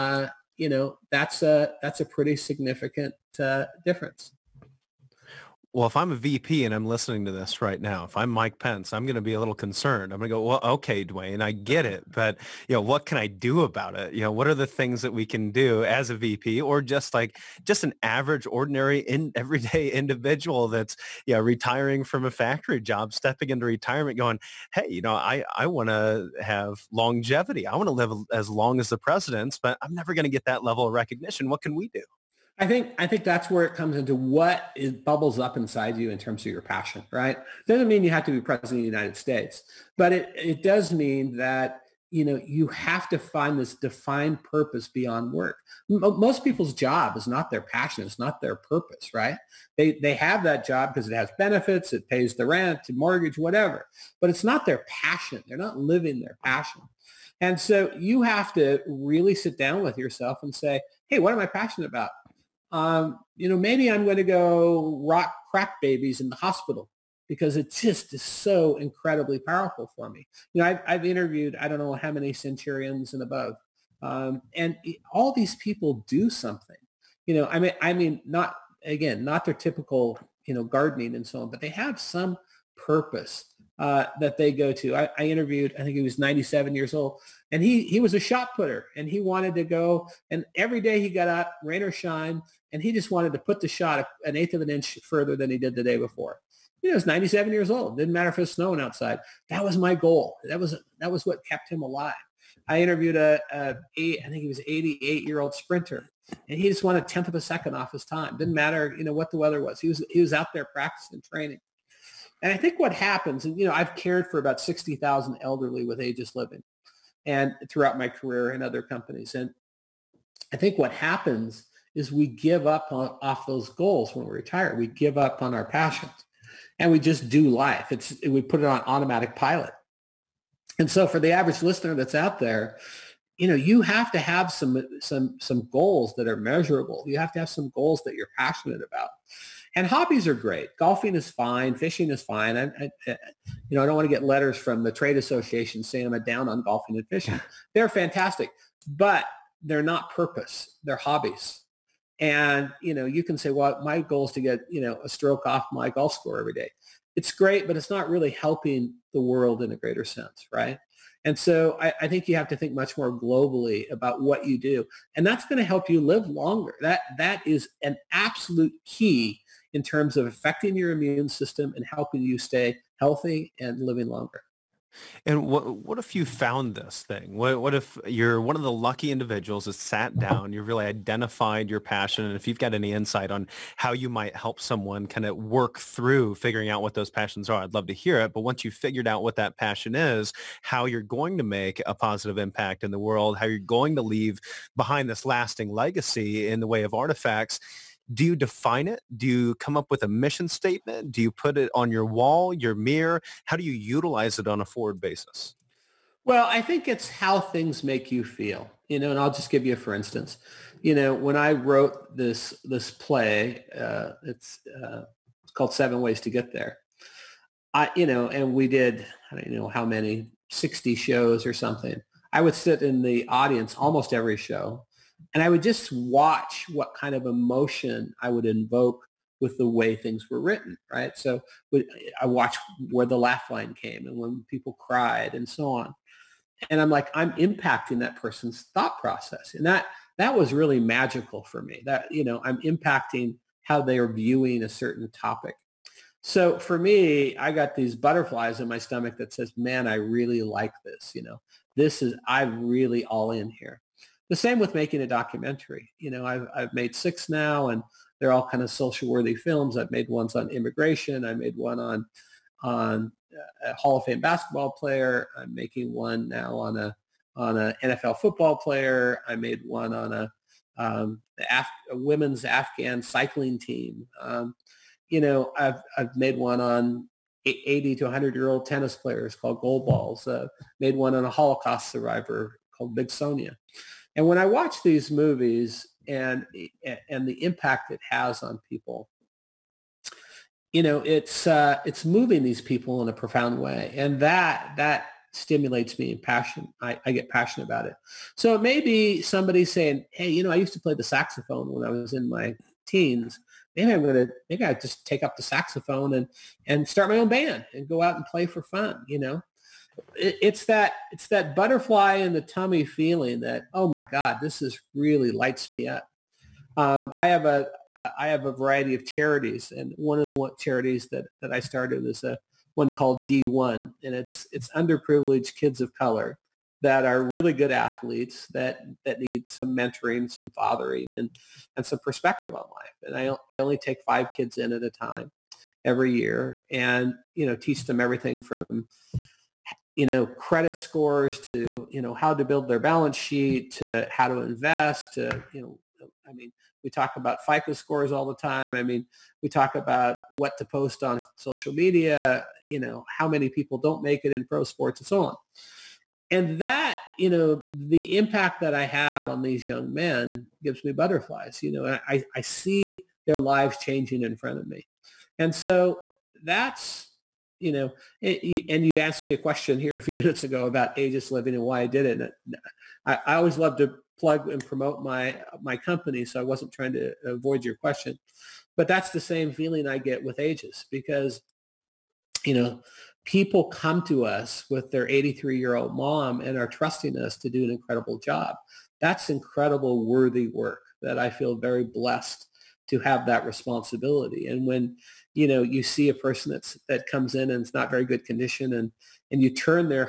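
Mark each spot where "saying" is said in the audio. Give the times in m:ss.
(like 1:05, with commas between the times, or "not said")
2:25, 4:59.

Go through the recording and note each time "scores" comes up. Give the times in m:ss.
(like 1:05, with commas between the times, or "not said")
2:36, 5:40, 5:47.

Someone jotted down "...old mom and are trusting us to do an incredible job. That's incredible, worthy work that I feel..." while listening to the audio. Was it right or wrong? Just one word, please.
right.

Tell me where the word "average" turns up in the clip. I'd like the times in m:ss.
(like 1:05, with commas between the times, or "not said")
0:18, 2:11.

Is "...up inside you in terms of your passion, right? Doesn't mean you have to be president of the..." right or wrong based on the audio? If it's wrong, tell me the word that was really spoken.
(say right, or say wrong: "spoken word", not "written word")
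right.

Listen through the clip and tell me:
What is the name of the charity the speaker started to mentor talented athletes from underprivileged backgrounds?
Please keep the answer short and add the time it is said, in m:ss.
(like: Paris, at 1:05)
D1, at 5:23.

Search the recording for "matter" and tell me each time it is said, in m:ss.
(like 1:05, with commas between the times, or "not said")
1:38, 1:48.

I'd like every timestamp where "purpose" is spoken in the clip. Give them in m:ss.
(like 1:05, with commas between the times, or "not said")
0:44, 0:48, 1:22, 2:30.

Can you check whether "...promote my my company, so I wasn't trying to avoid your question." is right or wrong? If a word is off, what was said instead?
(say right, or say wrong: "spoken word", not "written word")
right.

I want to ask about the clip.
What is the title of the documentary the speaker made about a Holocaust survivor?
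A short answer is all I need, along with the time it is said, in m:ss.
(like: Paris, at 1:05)
Big Sonia, at 4:42.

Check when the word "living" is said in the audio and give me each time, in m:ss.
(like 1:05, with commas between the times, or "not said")
0:55, 1:56, 2:53, 6:11.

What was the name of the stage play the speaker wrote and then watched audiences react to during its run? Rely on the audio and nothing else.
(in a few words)
Seven Ways to Get There.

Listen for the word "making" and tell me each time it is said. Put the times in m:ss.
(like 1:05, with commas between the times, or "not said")
4:14, 4:25.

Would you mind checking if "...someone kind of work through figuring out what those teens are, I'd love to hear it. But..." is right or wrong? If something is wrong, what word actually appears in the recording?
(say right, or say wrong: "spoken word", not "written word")
wrong: "passions", not "teens".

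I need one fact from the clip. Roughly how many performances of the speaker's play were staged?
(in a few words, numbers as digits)
60.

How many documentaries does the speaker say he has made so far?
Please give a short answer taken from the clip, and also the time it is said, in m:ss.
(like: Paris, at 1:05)
6, at 4:16.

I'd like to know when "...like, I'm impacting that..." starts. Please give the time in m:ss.
3:56.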